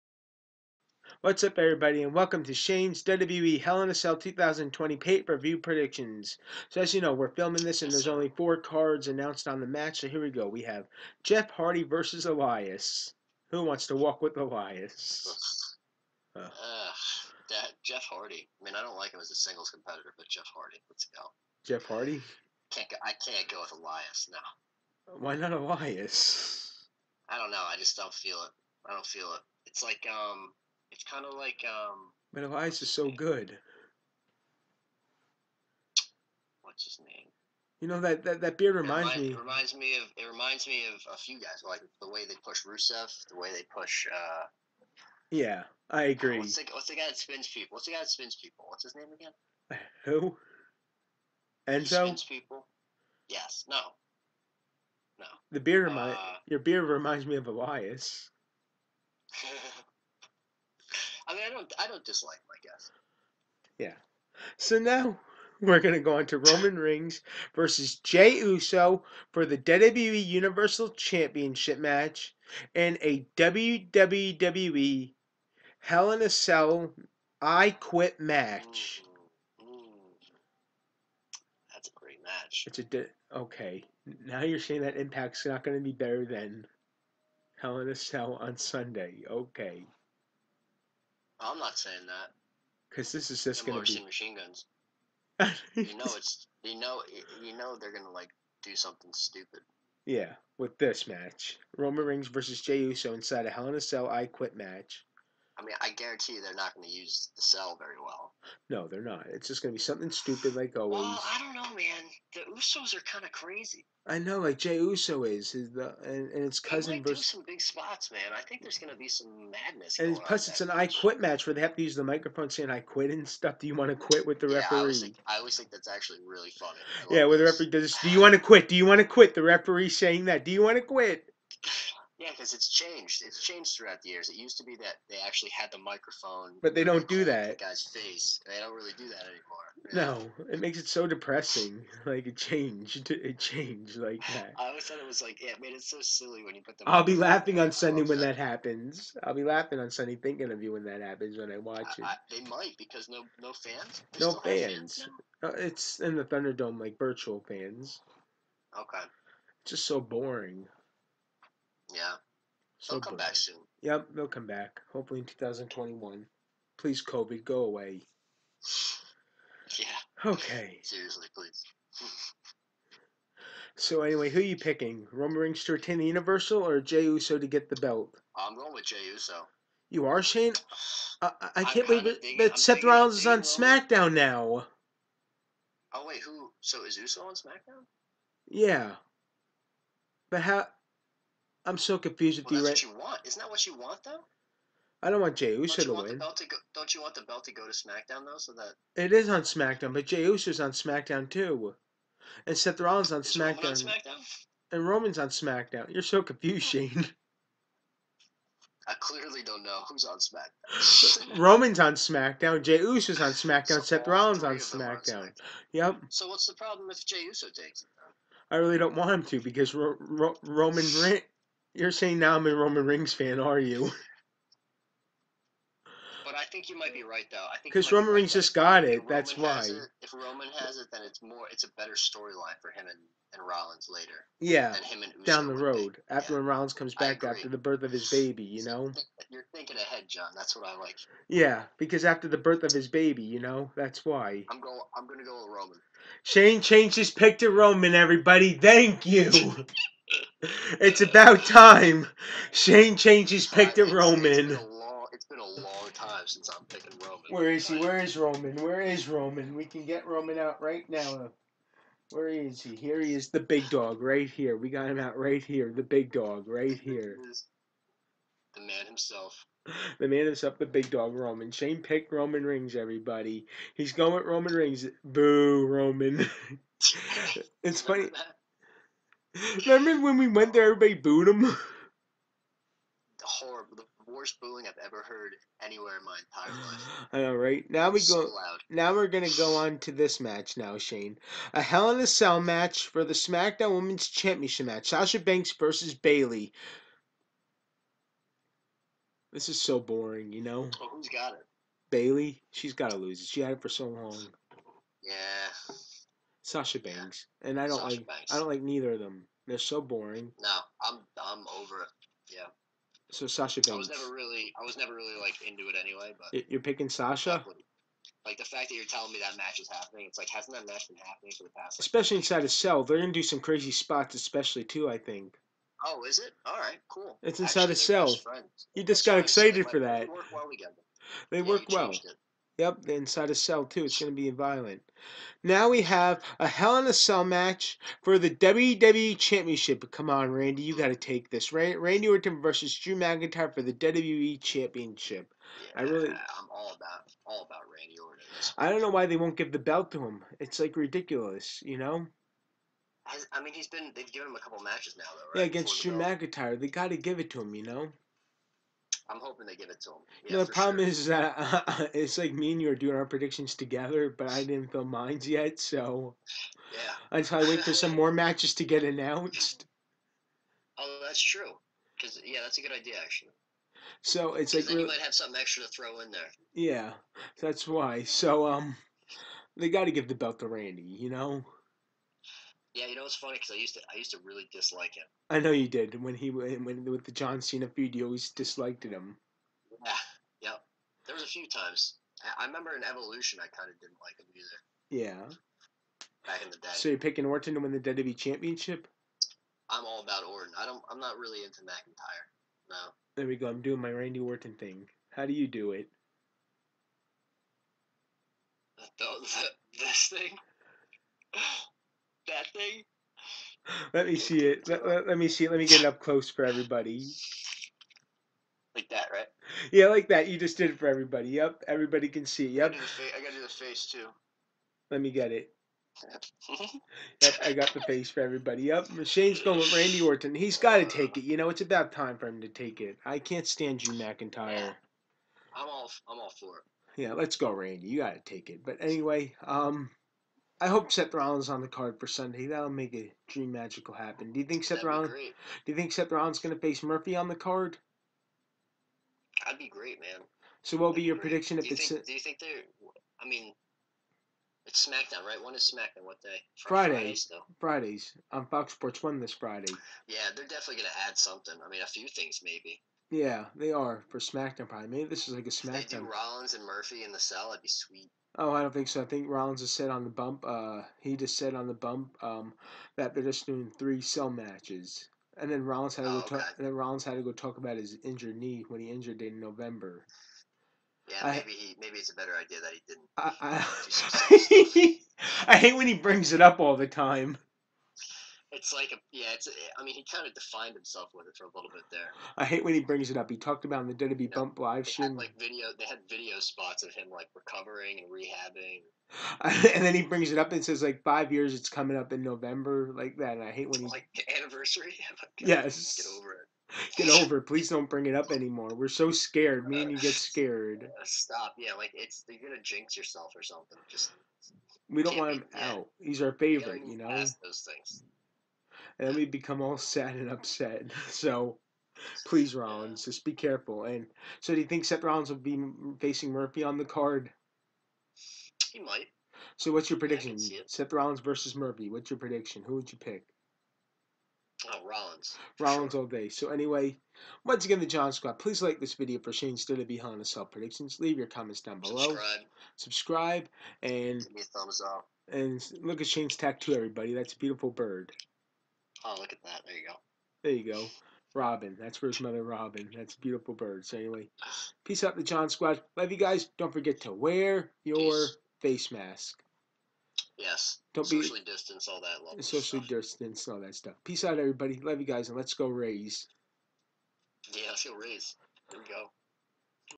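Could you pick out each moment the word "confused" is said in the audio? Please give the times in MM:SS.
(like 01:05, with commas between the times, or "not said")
03:11, 03:26.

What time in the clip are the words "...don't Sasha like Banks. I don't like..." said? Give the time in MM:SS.
05:07.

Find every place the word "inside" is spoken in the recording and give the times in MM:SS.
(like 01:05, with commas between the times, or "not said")
01:43, 05:22, 05:27, 05:32.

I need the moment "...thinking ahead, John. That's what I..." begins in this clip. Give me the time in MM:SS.
03:59.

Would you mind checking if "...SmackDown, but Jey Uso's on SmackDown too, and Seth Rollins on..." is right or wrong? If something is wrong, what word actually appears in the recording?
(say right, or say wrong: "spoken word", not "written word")
right.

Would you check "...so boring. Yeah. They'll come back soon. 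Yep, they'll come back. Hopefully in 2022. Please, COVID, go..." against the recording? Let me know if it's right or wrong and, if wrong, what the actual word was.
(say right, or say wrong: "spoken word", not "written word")
wrong: "2021", not "2022".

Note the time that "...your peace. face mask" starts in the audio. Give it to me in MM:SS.
09:17.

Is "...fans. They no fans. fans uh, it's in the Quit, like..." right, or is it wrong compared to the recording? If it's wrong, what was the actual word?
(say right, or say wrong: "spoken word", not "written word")
wrong: "Thunderdome", not "Quit".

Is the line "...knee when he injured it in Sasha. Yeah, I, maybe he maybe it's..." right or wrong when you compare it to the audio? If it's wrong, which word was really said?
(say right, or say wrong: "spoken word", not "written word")
wrong: "November", not "Sasha".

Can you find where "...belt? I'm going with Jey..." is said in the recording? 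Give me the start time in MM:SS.
02:57.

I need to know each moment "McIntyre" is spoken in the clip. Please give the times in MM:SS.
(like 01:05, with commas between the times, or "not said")
05:42, 05:55, 06:41, 07:13.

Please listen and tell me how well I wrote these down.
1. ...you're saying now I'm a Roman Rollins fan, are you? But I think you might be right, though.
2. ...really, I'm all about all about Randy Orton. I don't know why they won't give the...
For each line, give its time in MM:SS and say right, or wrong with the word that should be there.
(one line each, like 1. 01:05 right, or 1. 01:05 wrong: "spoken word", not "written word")
1. 03:41 wrong: "Reigns", not "Rollins"
2. 05:45 right.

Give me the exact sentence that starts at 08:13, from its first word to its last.
He talked about in the WWE yeah, Bump live show.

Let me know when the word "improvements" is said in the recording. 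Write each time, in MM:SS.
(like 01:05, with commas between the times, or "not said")
not said.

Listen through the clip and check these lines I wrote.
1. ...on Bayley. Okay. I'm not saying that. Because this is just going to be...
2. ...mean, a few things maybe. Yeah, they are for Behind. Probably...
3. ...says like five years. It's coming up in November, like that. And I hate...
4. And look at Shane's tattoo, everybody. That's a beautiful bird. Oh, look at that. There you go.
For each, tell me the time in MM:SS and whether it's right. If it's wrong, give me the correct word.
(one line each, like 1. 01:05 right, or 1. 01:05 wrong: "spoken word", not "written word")
1. 01:28 wrong: "Sunday", not "Bayley"
2. 07:41 wrong: "SmackDown", not "Behind"
3. 08:20 right
4. 09:05 right.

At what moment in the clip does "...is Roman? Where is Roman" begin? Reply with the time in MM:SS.
04:17.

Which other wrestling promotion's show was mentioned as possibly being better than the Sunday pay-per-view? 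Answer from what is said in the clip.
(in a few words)
Impact.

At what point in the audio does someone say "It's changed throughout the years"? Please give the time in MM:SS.
02:13.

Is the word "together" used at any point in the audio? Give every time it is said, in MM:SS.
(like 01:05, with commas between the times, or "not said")
05:30, 06:03.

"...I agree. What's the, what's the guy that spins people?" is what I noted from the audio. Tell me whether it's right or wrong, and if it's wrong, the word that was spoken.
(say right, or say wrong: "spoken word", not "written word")
right.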